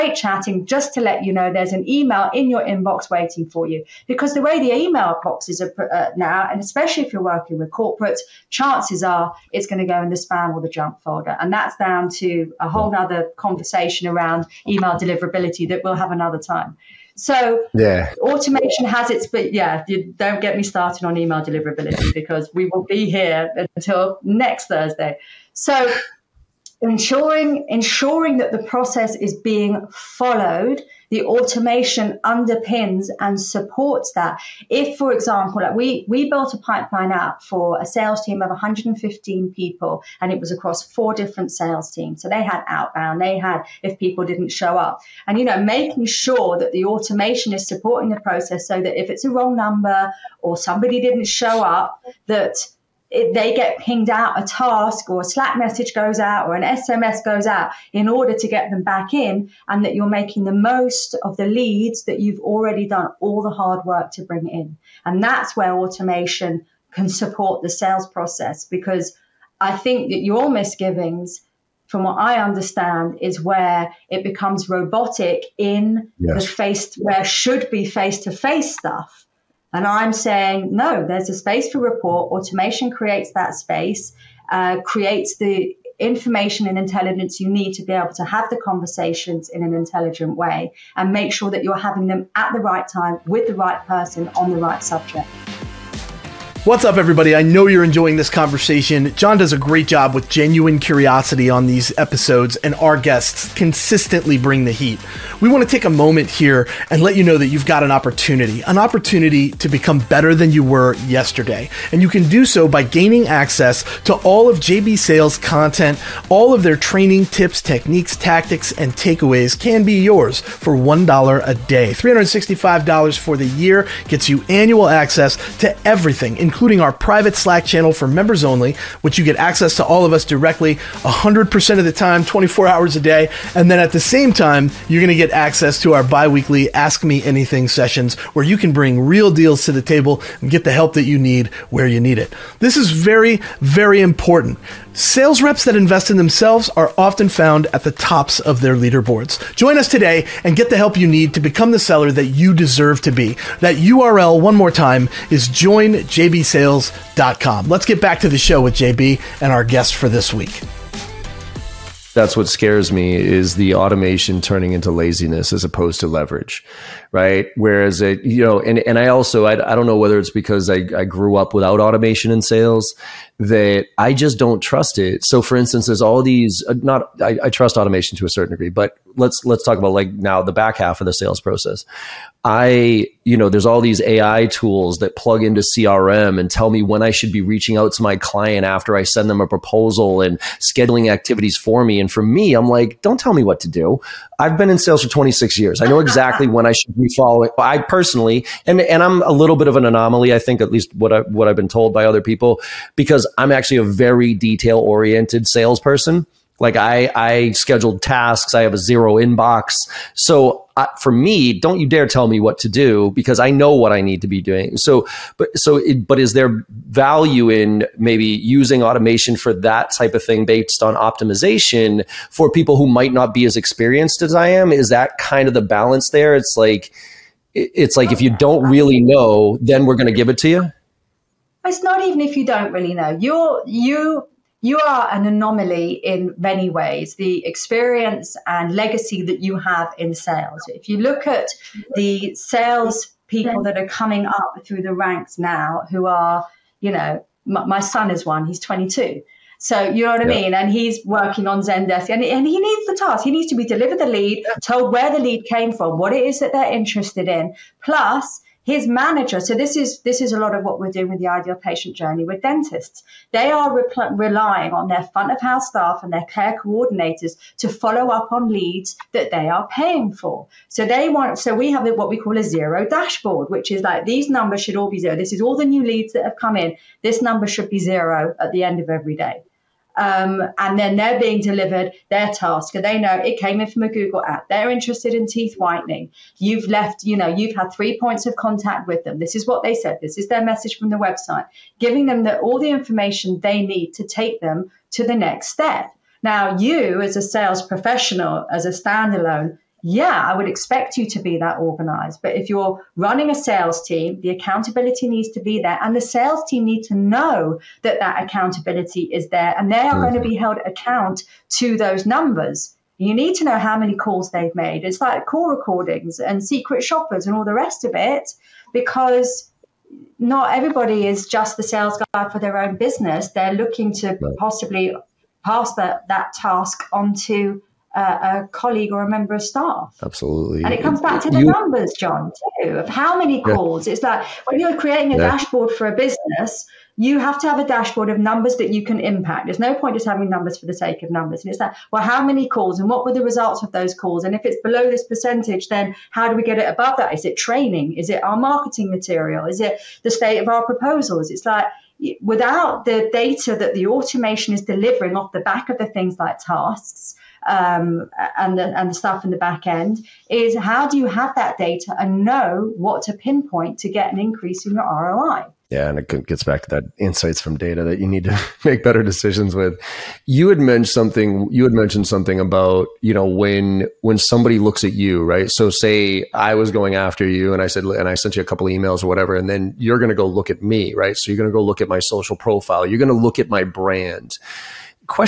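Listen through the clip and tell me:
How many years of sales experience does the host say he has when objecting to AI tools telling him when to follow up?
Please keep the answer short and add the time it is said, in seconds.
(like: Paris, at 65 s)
26 years, at 195 s.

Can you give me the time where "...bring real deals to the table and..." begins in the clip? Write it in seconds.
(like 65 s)
138 s.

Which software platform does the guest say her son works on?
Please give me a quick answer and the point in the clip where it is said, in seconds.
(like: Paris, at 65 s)
Zendesk, at 251 s.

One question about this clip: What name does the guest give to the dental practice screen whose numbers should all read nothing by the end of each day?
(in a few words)
zero dashboard.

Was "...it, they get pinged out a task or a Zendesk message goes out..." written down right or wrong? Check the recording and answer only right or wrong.
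wrong.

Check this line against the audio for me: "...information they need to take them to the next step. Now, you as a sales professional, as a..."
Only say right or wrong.
right.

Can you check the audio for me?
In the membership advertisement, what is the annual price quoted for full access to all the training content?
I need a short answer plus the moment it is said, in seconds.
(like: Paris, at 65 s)
$365, at 121 s.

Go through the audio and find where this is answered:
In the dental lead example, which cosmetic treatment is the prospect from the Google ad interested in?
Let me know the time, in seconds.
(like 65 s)
285 s.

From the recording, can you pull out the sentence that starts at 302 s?
But if you're running a sales team, the accountability needs to be there.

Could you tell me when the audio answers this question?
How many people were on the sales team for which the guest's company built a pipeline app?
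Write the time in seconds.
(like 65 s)
38 s.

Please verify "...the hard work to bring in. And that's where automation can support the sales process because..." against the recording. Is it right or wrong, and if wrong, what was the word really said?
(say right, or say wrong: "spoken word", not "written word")
right.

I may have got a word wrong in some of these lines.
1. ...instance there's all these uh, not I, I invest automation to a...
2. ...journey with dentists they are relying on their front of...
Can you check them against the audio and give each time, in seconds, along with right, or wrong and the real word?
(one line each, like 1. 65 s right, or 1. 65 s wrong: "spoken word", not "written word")
1. 175 s wrong: "trust", not "invest"
2. 261 s right.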